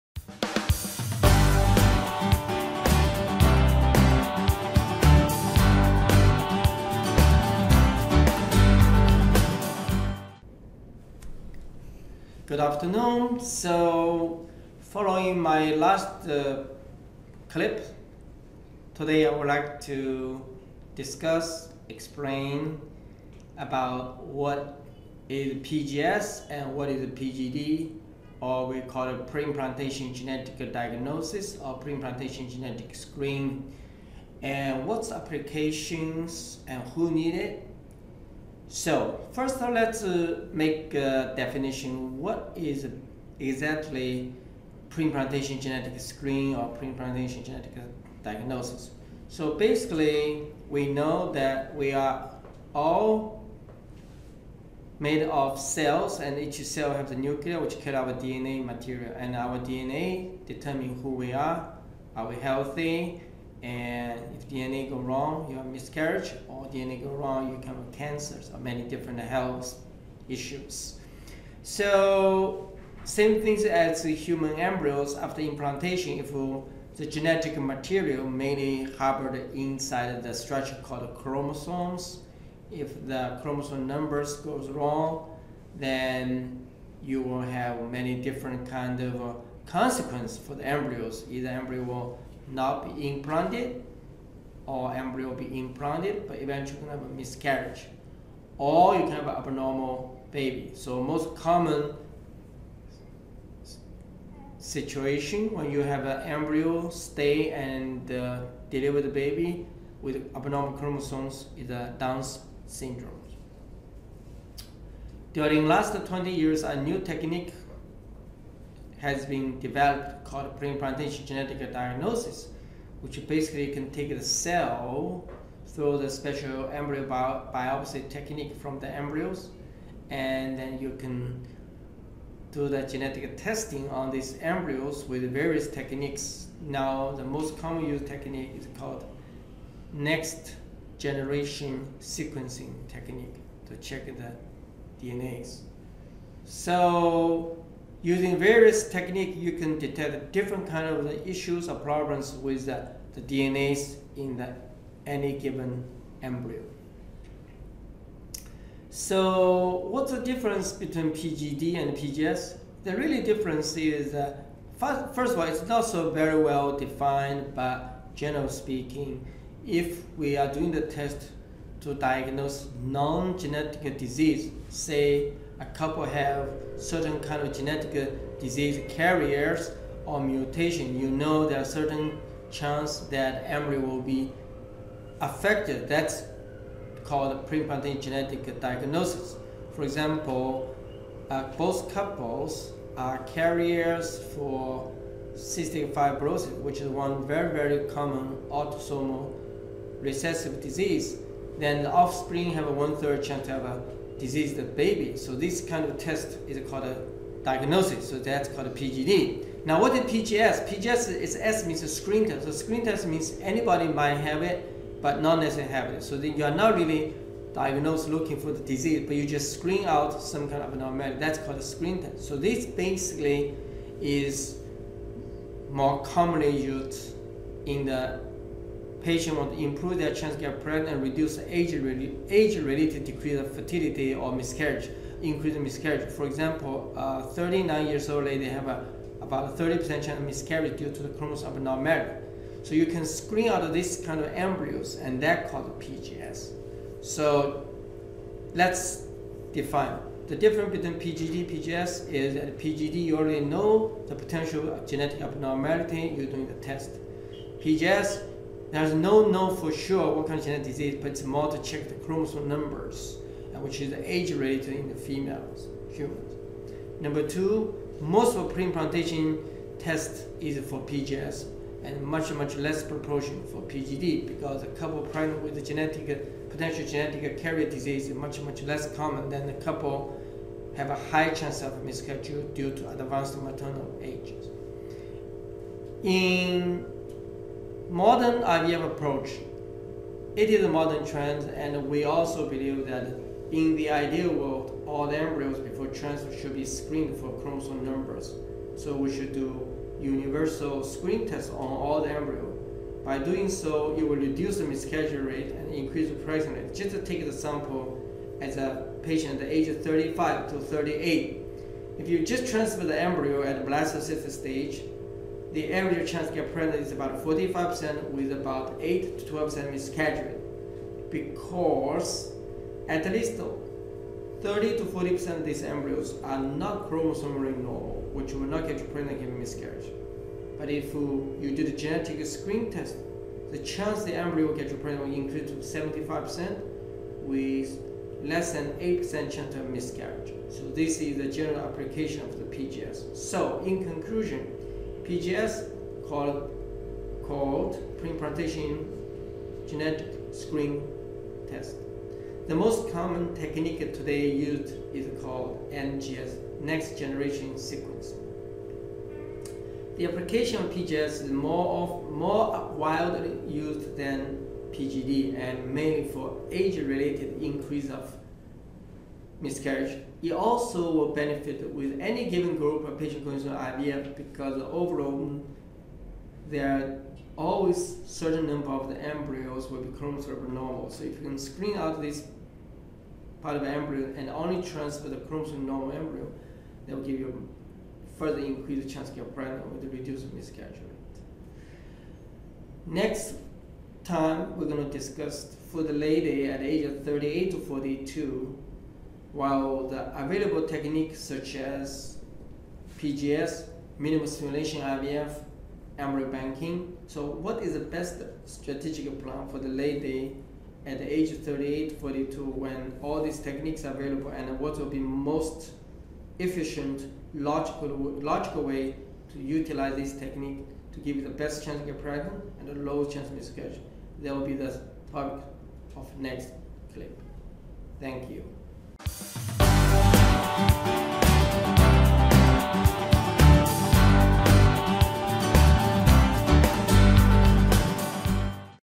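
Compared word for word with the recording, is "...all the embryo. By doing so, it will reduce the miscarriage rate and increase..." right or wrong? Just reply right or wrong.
right.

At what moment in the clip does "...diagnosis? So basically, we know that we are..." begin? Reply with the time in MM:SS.
00:48.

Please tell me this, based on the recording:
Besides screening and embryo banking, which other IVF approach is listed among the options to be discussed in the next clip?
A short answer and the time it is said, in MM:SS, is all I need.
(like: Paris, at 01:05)
minimal stimulation IVF, at 06:43.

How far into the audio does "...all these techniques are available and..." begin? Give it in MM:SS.
06:53.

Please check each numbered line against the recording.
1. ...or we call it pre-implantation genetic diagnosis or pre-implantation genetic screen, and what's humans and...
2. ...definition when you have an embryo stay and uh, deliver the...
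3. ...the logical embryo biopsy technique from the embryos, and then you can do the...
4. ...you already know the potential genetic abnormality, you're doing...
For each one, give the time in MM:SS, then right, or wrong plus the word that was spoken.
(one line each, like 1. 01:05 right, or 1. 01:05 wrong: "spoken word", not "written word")
1. 00:28 wrong: "applications", not "humans"
2. 01:44 wrong: "situation", not "definition"
3. 02:05 wrong: "special", not "logical"
4. 04:13 right.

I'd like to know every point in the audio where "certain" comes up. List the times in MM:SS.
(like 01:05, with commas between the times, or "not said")
02:56, 03:01, 06:18.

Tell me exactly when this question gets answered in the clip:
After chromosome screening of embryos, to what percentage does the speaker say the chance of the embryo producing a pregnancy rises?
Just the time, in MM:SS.
05:35.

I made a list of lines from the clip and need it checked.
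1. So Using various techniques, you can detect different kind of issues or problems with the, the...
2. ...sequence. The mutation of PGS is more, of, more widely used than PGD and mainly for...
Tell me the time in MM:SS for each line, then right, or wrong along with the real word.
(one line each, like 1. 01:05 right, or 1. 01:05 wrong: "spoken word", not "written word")
1. 02:26 right
2. 05:57 wrong: "application", not "mutation".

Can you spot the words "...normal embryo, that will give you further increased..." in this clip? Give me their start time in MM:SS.
06:25.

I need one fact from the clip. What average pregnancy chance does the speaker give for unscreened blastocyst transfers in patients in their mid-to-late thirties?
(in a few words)
45%.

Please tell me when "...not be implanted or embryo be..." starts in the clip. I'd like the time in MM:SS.
01:32.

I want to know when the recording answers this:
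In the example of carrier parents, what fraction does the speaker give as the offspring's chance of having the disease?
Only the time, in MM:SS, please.
03:22.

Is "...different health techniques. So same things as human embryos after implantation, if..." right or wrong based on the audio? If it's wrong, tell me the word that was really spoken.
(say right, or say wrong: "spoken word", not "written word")
wrong: "issues", not "techniques".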